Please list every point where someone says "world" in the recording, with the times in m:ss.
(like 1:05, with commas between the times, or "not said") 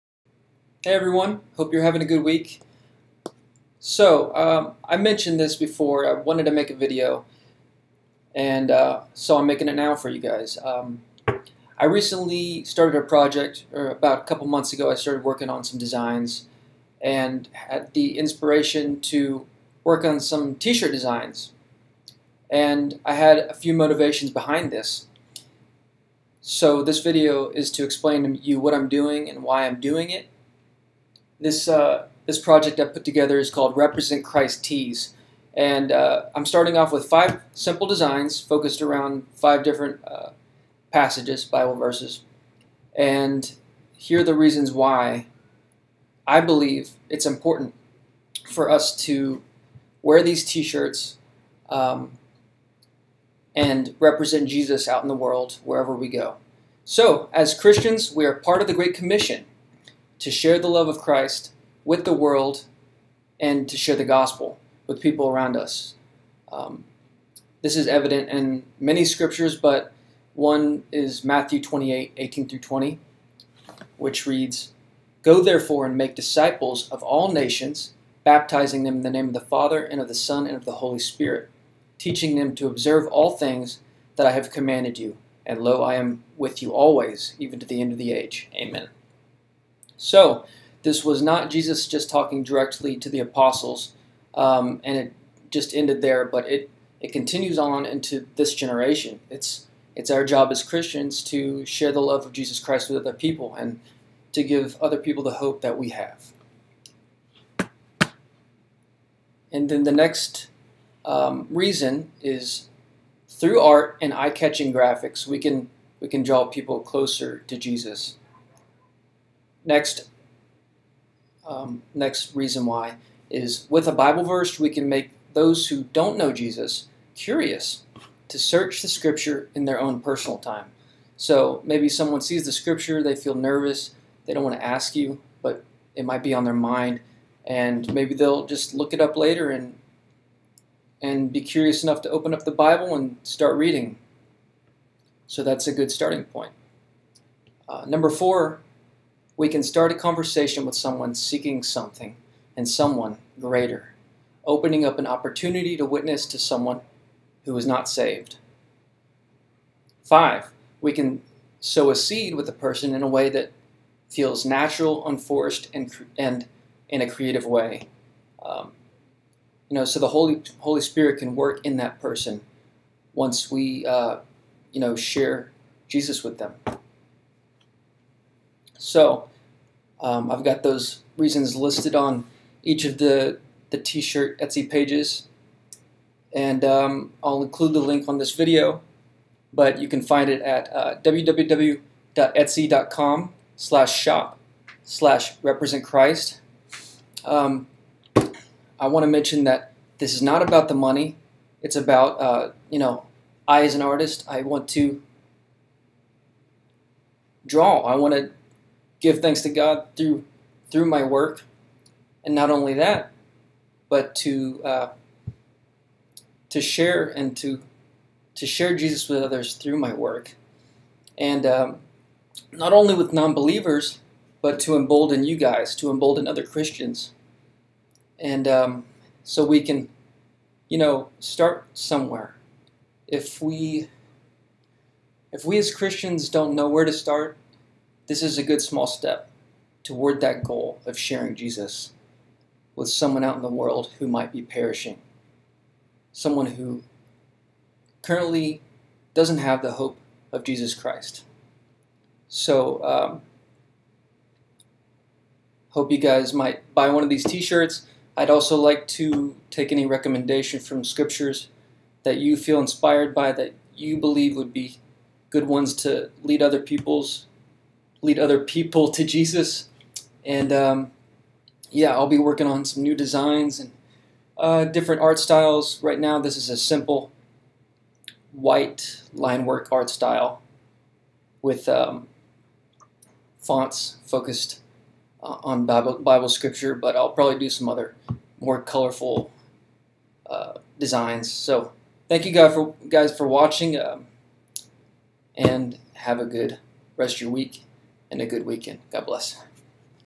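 0:55, 1:02, 4:03.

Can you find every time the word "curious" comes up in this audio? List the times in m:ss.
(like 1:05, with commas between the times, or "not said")
2:07, 2:21.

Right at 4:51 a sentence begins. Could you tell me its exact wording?
So thank you guys for, guys for watching um, and have a good rest of your week and a good weekend.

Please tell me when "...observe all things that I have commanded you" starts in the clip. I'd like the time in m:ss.
1:22.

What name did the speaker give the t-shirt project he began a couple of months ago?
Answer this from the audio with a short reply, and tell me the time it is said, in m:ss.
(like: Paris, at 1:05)
Represent Christ Tees, at 0:33.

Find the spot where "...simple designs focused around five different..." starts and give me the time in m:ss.
0:37.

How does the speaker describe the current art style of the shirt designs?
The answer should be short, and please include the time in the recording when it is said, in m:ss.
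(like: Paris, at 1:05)
simple white line work, at 4:36.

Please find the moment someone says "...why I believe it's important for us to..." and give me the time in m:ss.
0:44.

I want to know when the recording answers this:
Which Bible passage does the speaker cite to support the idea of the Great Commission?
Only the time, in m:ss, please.
1:11.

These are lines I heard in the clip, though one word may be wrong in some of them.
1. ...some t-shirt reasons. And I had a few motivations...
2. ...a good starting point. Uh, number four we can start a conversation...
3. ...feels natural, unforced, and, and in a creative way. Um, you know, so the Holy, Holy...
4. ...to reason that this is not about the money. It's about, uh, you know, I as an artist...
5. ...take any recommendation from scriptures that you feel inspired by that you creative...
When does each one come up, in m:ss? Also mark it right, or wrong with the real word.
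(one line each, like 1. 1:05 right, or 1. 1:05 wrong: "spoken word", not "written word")
1. 0:20 wrong: "designs", not "reasons"
2. 2:25 right
3. 2:44 right
4. 3:19 wrong: "mention", not "reason"
5. 4:19 wrong: "believe", not "creative".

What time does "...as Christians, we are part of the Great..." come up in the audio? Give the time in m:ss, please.
0:57.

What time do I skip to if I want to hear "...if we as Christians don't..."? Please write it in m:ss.
3:55.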